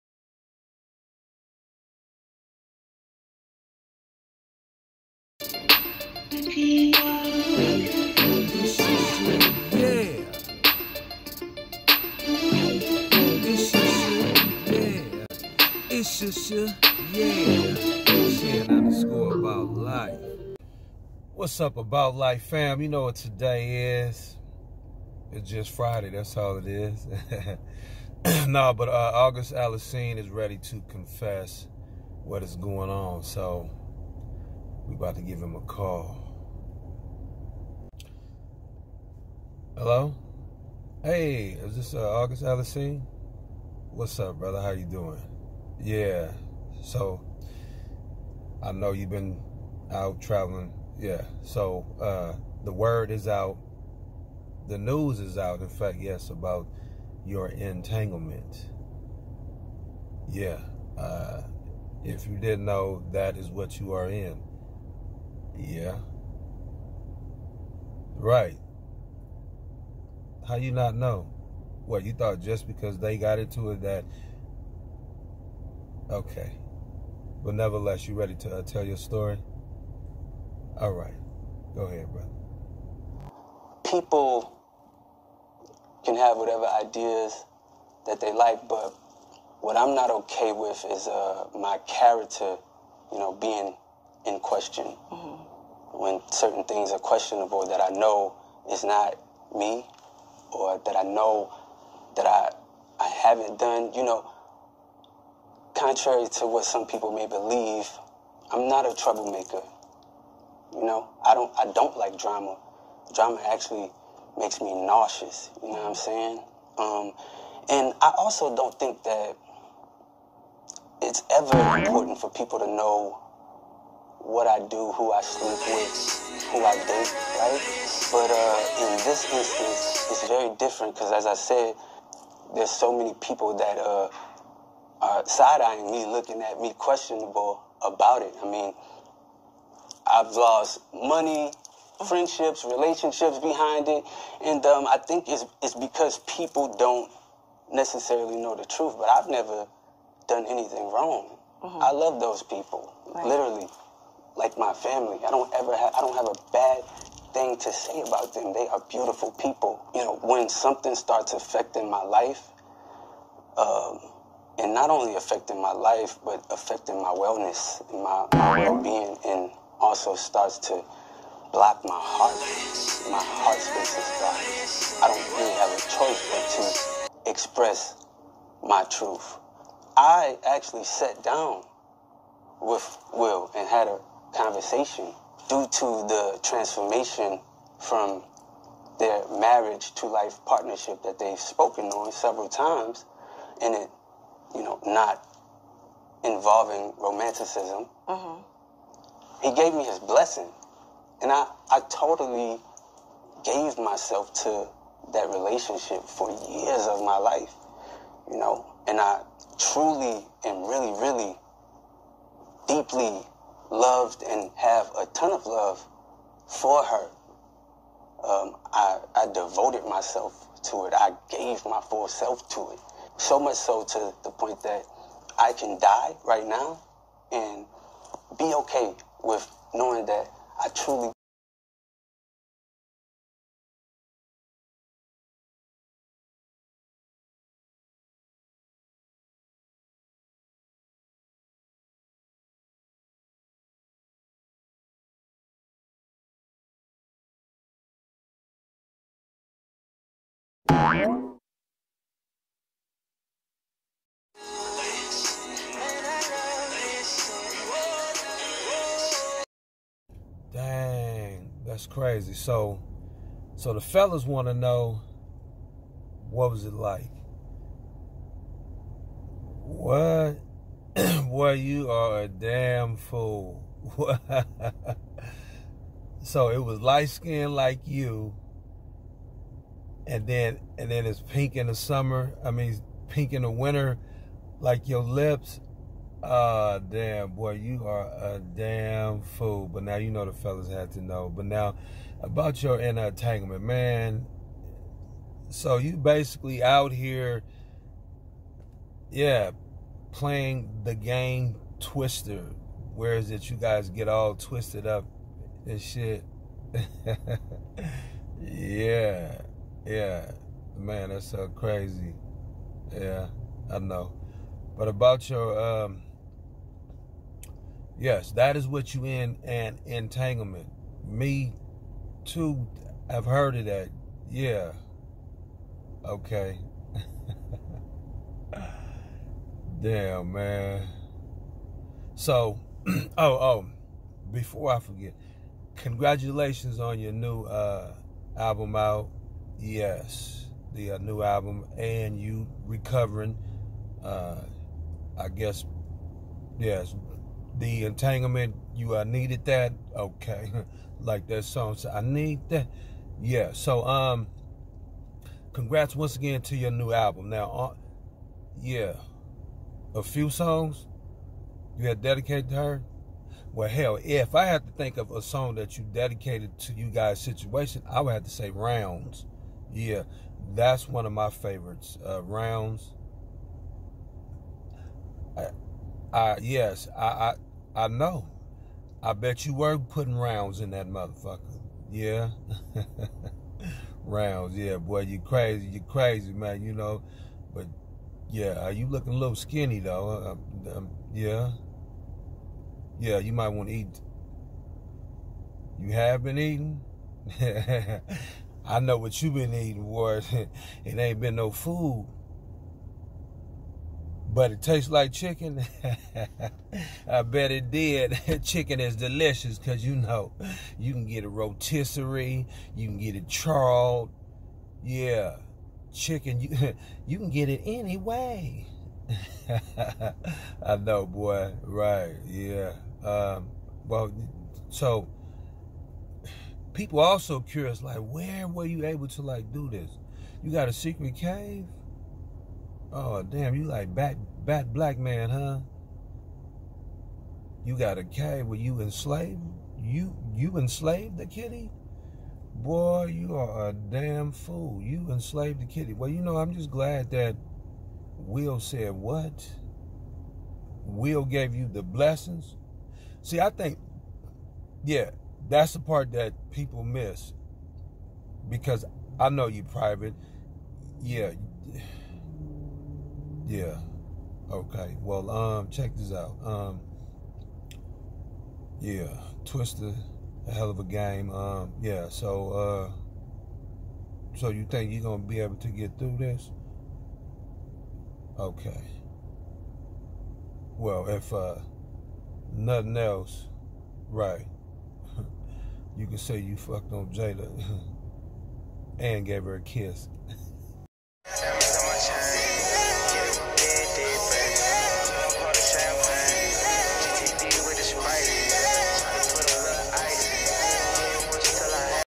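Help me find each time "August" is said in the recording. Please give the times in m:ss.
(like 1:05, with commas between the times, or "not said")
0:29, 0:42.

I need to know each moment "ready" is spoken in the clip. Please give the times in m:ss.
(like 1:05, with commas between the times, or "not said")
0:30, 1:18.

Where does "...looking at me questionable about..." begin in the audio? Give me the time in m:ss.
2:16.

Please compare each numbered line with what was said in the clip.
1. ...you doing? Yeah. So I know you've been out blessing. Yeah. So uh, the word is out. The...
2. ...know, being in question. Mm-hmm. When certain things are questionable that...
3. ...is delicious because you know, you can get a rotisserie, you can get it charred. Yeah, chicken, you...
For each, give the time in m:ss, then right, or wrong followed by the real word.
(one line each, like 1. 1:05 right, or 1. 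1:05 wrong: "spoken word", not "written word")
1. 0:44 wrong: "traveling", not "blessing"
2. 1:33 right
3. 6:48 right.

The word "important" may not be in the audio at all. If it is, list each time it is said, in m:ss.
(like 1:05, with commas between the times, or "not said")
2:01.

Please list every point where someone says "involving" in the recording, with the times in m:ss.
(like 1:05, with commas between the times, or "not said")
3:16.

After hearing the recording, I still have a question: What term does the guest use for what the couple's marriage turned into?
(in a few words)
life partnership.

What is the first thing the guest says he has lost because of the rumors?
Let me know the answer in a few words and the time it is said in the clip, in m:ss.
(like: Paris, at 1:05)
money, at 2:20.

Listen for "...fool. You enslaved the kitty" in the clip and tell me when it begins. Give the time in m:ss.
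7:24.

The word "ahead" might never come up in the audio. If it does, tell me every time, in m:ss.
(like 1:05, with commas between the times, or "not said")
1:21.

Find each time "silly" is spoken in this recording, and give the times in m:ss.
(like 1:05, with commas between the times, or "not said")
not said.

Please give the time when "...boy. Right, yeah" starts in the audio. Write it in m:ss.
7:01.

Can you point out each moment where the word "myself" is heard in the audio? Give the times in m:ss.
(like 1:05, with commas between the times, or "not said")
3:23, 3:39.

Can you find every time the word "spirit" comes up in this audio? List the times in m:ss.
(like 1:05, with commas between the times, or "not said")
not said.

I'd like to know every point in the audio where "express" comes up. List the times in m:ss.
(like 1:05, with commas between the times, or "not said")
2:57.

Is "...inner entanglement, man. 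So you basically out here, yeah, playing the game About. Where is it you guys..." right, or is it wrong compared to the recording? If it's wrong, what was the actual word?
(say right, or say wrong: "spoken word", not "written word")
wrong: "Twister", not "About".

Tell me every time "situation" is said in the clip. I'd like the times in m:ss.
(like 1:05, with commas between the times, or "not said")
6:07.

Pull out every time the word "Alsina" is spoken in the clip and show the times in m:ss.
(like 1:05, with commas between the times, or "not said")
0:29, 0:42.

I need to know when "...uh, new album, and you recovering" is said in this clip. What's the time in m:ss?
5:40.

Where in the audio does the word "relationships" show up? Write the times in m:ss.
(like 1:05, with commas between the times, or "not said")
2:22, 3:25.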